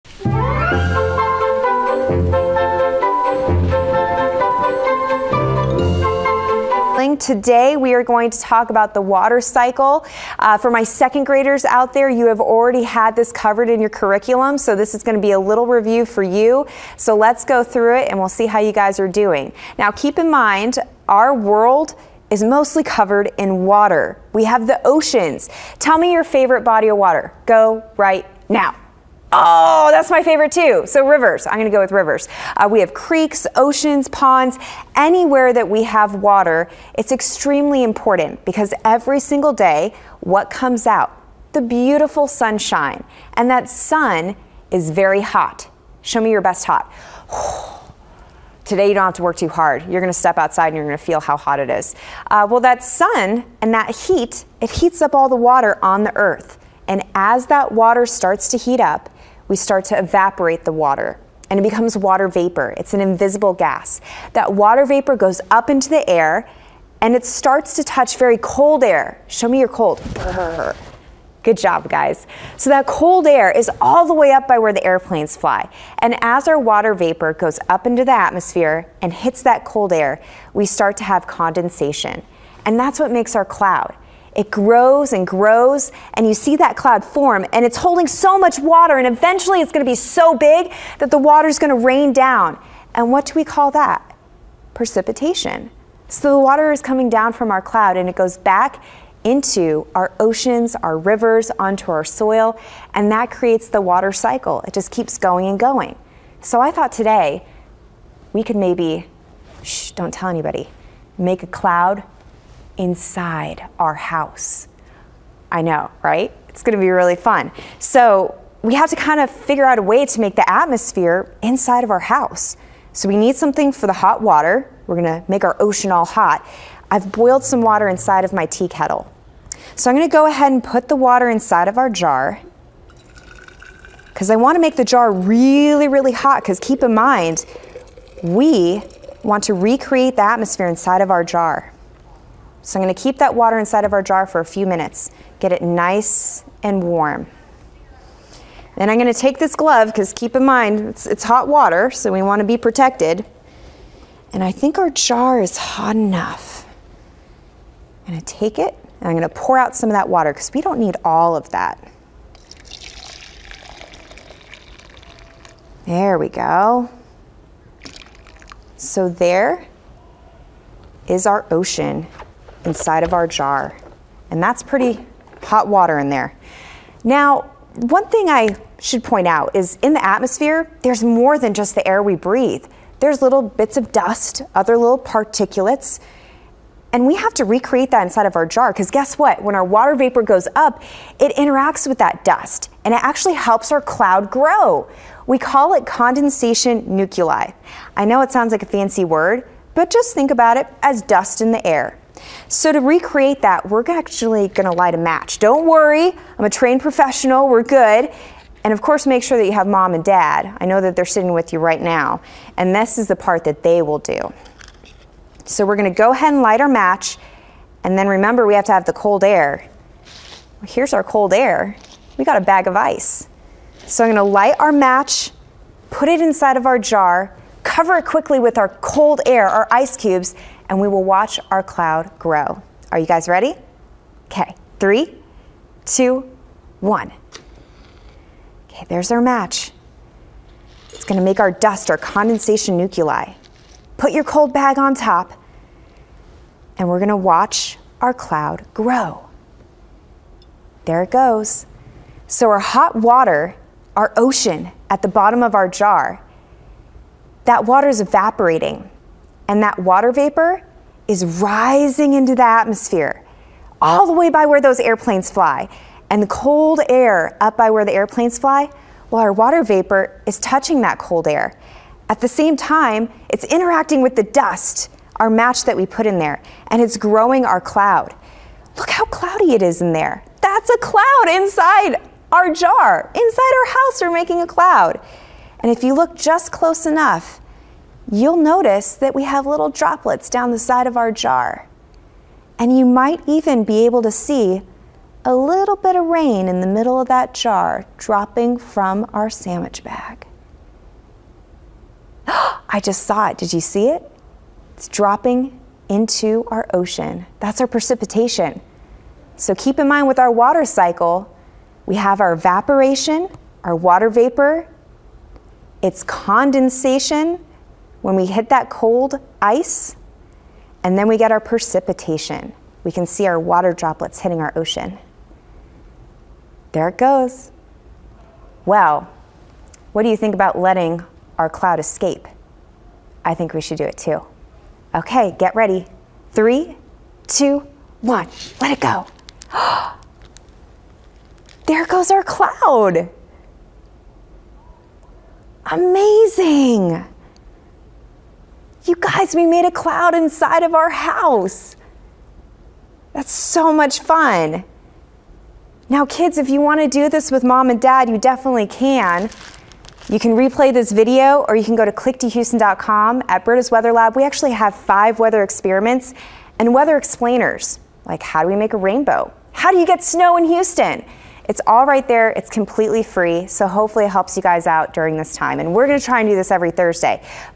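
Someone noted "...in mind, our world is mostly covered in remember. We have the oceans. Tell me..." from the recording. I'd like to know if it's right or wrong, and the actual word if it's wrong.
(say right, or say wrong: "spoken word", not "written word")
wrong: "water", not "remember".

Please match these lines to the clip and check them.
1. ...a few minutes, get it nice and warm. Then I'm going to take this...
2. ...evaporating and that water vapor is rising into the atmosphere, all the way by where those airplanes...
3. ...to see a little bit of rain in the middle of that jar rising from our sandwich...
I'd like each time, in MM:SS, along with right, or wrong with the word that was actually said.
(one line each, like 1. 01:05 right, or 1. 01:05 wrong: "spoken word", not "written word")
1. 02:24 right
2. 04:17 right
3. 04:54 wrong: "dropping", not "rising".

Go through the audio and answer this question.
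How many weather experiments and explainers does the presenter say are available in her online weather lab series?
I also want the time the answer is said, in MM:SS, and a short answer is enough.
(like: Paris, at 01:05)
5, at 06:04.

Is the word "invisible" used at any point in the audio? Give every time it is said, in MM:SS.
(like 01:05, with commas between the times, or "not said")
01:03.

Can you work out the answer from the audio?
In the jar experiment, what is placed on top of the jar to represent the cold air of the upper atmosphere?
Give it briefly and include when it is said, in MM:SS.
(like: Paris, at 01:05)
A bag of ice, at 03:42.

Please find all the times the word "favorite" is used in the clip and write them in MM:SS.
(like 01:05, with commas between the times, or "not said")
00:26, 00:30.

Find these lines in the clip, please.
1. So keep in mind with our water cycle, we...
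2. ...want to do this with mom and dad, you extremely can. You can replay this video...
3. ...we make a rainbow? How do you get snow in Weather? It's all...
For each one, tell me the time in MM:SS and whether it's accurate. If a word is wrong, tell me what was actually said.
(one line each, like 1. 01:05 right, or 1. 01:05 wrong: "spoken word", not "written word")
1. 05:09 right
2. 05:56 wrong: "definitely", not "extremely"
3. 06:08 wrong: "Houston", not "Weather".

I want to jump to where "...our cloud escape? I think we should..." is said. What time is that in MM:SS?
05:31.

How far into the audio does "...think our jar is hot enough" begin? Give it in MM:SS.
02:34.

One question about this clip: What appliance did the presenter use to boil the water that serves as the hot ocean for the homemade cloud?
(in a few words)
Tea kettle.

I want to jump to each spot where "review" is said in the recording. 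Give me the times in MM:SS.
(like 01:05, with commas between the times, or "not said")
00:15.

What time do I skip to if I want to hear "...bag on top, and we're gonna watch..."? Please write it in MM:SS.
04:04.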